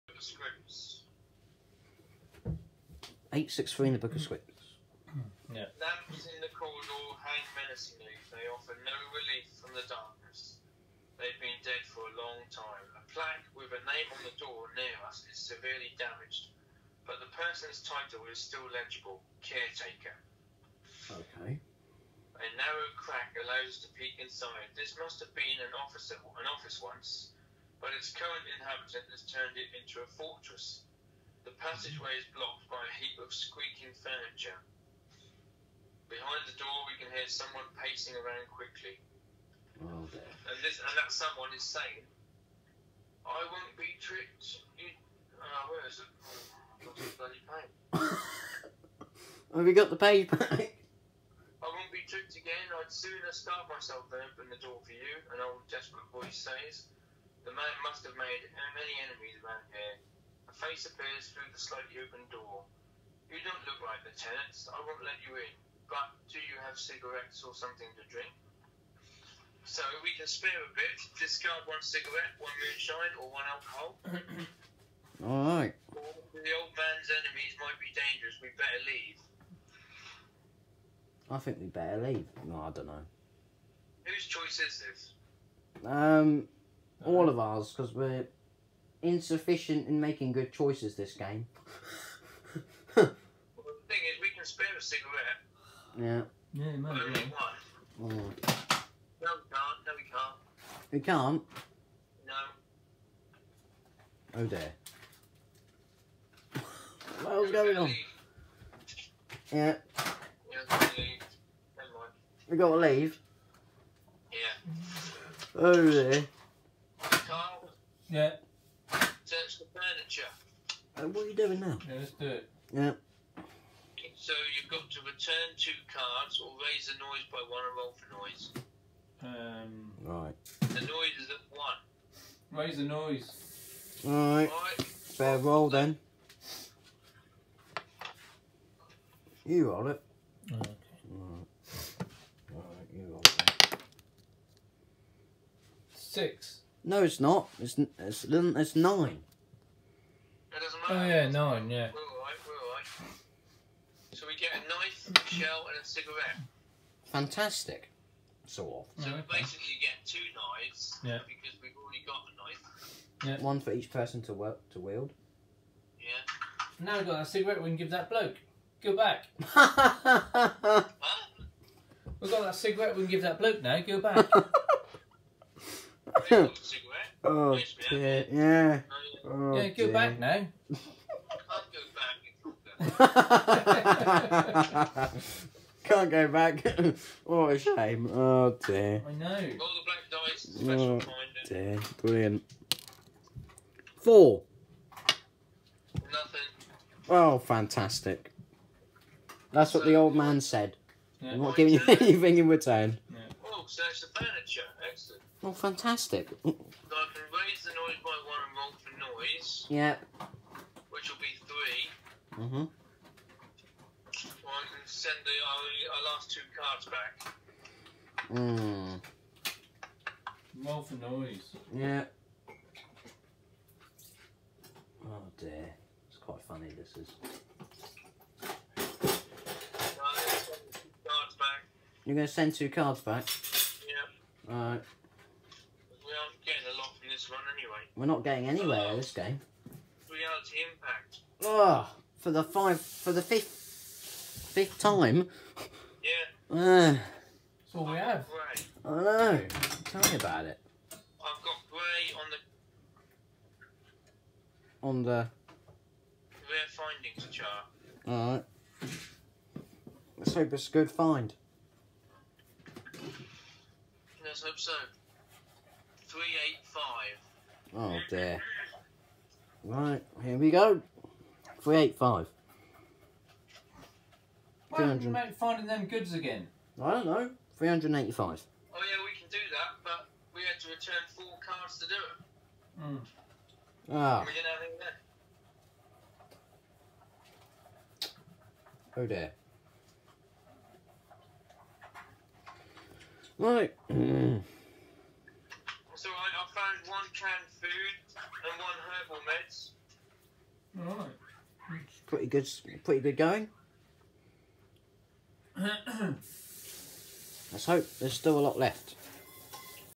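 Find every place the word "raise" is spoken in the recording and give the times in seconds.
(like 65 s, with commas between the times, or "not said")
126 s, 132 s, 207 s.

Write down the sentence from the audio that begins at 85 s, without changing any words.
Um, all of ours, because we're insufficient in making good choices this game.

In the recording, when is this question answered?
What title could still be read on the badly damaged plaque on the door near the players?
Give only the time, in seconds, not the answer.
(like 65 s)
19 s.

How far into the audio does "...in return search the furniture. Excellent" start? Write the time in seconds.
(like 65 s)
202 s.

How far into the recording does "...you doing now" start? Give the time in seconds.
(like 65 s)
121 s.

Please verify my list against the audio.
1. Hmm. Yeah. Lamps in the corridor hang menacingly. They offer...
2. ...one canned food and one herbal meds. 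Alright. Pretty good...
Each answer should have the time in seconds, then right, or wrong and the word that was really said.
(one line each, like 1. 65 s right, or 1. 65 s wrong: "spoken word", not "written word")
1. 5 s right
2. 296 s right.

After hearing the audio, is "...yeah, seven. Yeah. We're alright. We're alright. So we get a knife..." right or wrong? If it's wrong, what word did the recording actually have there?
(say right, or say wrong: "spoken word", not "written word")
wrong: "nine", not "seven".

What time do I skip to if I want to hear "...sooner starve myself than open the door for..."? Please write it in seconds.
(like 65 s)
52 s.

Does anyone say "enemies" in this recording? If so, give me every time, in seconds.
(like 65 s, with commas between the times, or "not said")
59 s, 77 s.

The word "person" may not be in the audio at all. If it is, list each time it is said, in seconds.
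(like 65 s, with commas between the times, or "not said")
17 s, 163 s.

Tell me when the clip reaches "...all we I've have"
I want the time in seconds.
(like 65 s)
247 s.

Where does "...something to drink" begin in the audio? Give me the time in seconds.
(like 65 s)
67 s.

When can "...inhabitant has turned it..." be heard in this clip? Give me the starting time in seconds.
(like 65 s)
28 s.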